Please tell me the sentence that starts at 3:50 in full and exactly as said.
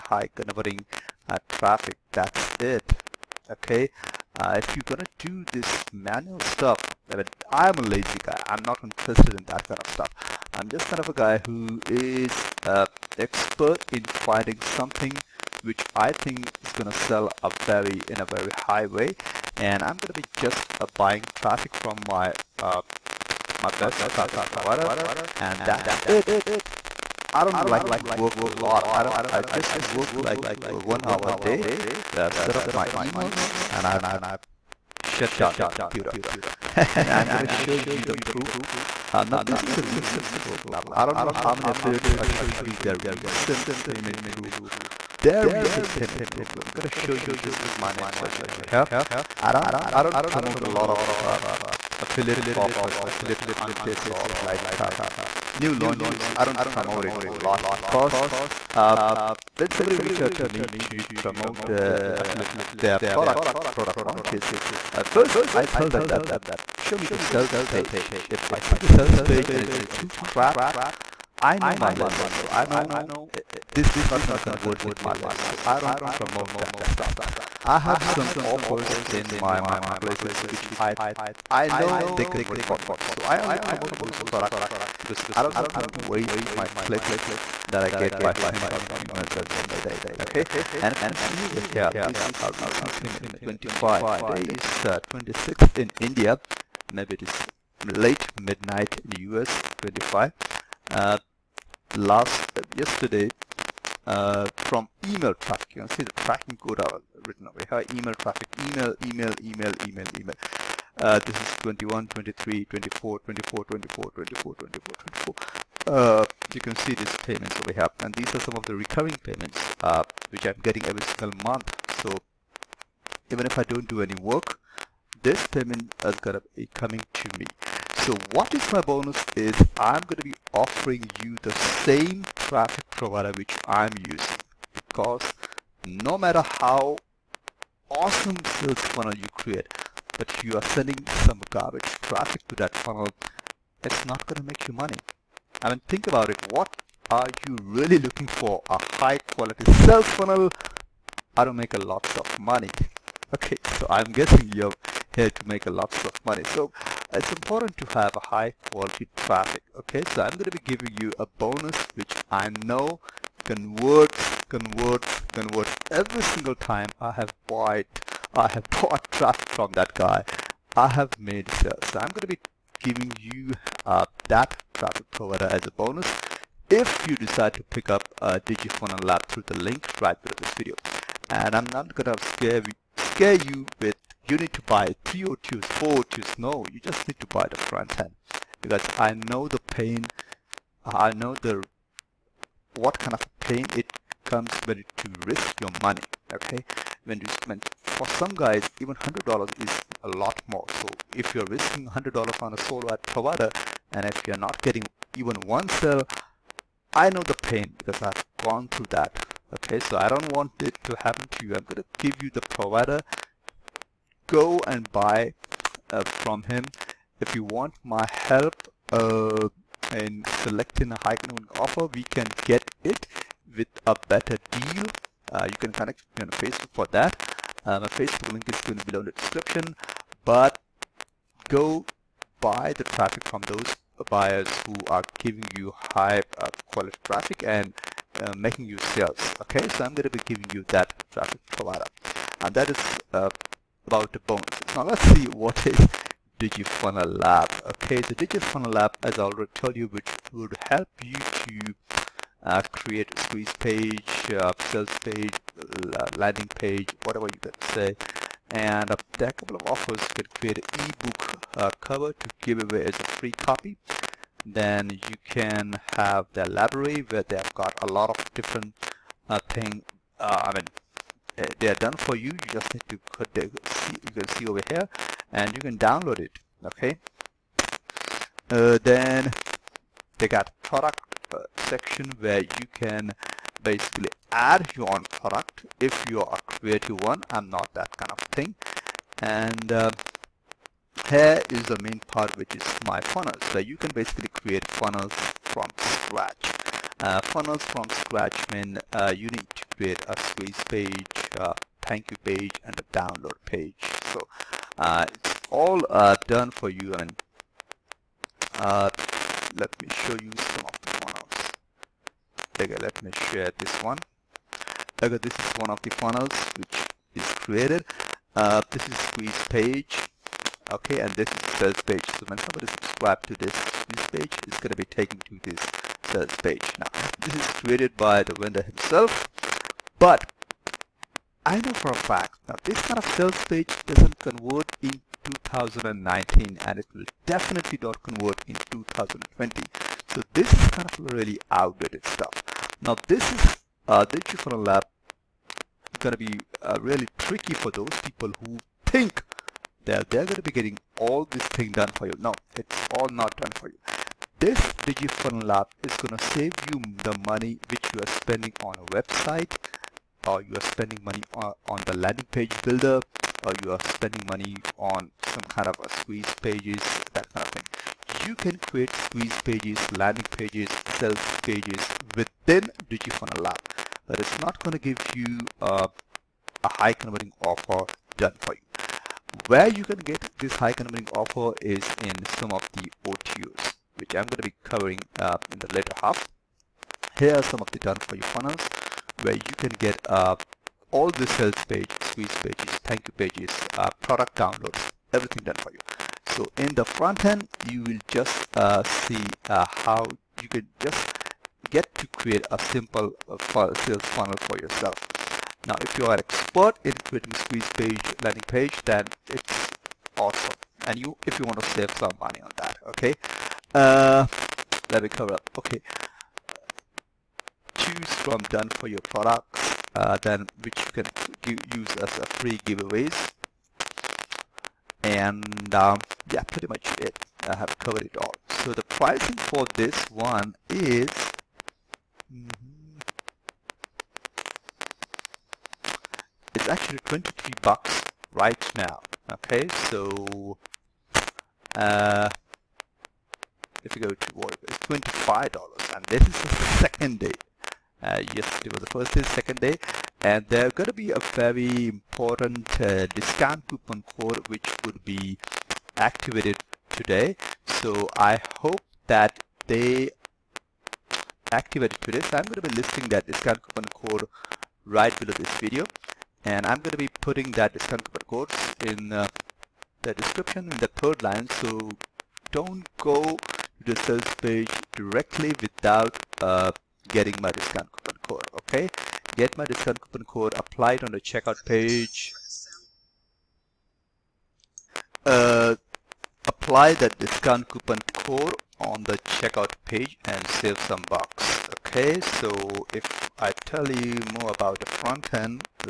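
But go buy the traffic from those buyers who are giving you high uh, quality traffic and uh, making you sales.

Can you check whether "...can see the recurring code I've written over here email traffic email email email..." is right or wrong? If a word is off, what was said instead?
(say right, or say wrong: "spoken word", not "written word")
wrong: "tracking", not "recurring".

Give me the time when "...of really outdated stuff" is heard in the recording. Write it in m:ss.
5:40.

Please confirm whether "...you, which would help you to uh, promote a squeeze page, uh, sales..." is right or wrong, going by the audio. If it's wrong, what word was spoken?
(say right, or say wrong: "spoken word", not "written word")
wrong: "create", not "promote".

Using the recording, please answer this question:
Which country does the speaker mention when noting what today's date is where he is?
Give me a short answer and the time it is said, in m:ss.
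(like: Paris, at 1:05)
India, at 1:35.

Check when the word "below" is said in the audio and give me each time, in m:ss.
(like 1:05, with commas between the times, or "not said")
3:00, 3:48, 7:45.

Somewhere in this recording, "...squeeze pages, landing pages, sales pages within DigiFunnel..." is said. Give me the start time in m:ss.
6:08.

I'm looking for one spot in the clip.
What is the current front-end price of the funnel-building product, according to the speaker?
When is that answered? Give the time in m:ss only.
7:17.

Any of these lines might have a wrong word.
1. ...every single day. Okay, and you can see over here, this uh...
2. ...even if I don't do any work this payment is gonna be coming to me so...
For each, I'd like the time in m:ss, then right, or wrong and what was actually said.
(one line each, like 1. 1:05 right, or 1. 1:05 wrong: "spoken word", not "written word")
1. 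1:29 right
2. 2:03 right.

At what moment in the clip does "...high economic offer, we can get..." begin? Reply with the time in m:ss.
3:41.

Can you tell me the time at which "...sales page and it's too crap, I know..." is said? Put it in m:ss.
1:08.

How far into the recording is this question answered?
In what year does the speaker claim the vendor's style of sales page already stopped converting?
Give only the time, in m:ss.
5:35.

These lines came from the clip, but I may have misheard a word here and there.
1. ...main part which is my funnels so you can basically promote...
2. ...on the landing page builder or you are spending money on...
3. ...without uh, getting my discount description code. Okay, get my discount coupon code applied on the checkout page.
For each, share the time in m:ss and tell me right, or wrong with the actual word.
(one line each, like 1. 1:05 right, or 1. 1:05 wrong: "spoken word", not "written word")
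1. 4:51 wrong: "create", not "promote"
2. 6:01 right
3. 7:55 wrong: "coupon", not "description".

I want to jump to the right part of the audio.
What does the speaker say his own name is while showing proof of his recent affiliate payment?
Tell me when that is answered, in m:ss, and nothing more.
0:48.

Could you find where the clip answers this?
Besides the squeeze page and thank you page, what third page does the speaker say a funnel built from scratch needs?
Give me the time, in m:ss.
5:02.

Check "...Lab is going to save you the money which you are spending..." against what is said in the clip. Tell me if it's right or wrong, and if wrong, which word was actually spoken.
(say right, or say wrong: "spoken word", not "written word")
right.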